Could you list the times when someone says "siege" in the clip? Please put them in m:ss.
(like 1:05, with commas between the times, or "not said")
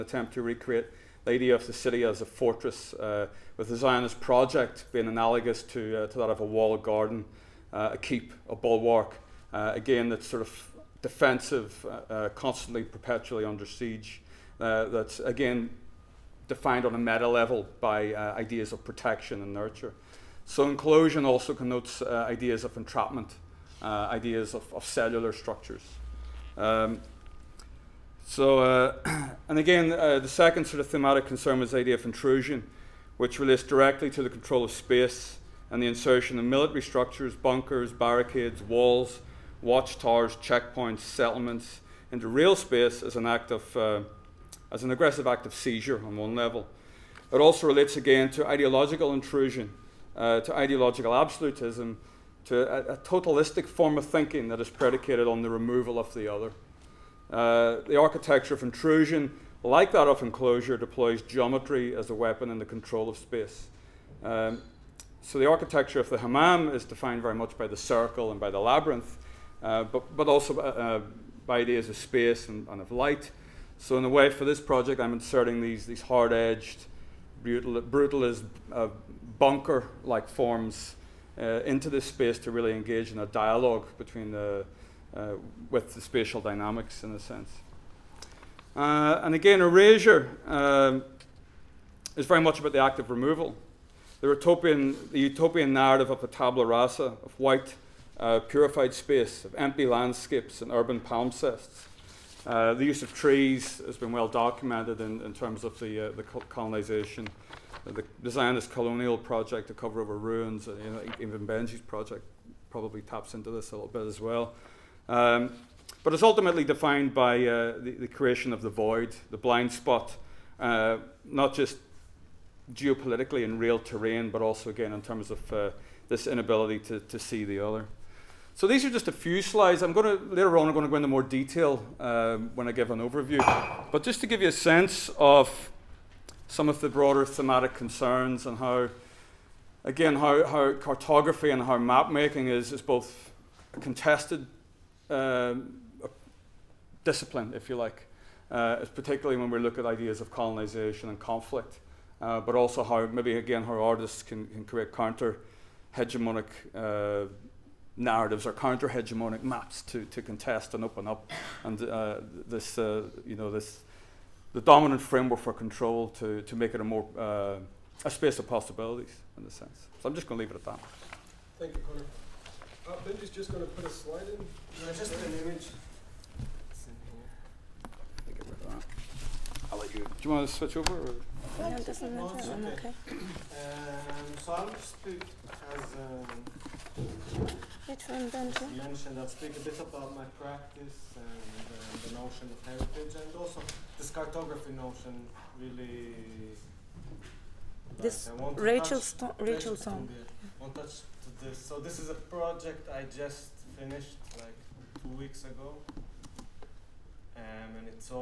0:13.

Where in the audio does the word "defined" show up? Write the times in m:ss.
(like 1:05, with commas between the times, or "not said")
0:16, 1:06, 1:56.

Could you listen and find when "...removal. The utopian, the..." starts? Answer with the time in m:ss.
1:33.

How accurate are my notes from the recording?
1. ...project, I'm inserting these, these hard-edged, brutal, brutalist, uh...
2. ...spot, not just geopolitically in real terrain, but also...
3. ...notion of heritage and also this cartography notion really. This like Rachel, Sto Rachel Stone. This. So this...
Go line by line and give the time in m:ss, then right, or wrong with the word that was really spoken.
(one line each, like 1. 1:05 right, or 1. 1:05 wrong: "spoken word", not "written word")
1. 1:14 right
2. 1:59 right
3. 3:12 right.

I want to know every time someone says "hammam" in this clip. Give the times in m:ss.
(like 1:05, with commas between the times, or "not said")
1:06.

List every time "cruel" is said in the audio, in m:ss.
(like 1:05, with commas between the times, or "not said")
not said.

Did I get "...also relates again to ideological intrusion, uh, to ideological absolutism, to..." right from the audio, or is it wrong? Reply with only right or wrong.
right.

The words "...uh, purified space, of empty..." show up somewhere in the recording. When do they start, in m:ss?
1:38.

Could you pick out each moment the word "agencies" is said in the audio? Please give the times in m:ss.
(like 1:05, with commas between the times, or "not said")
not said.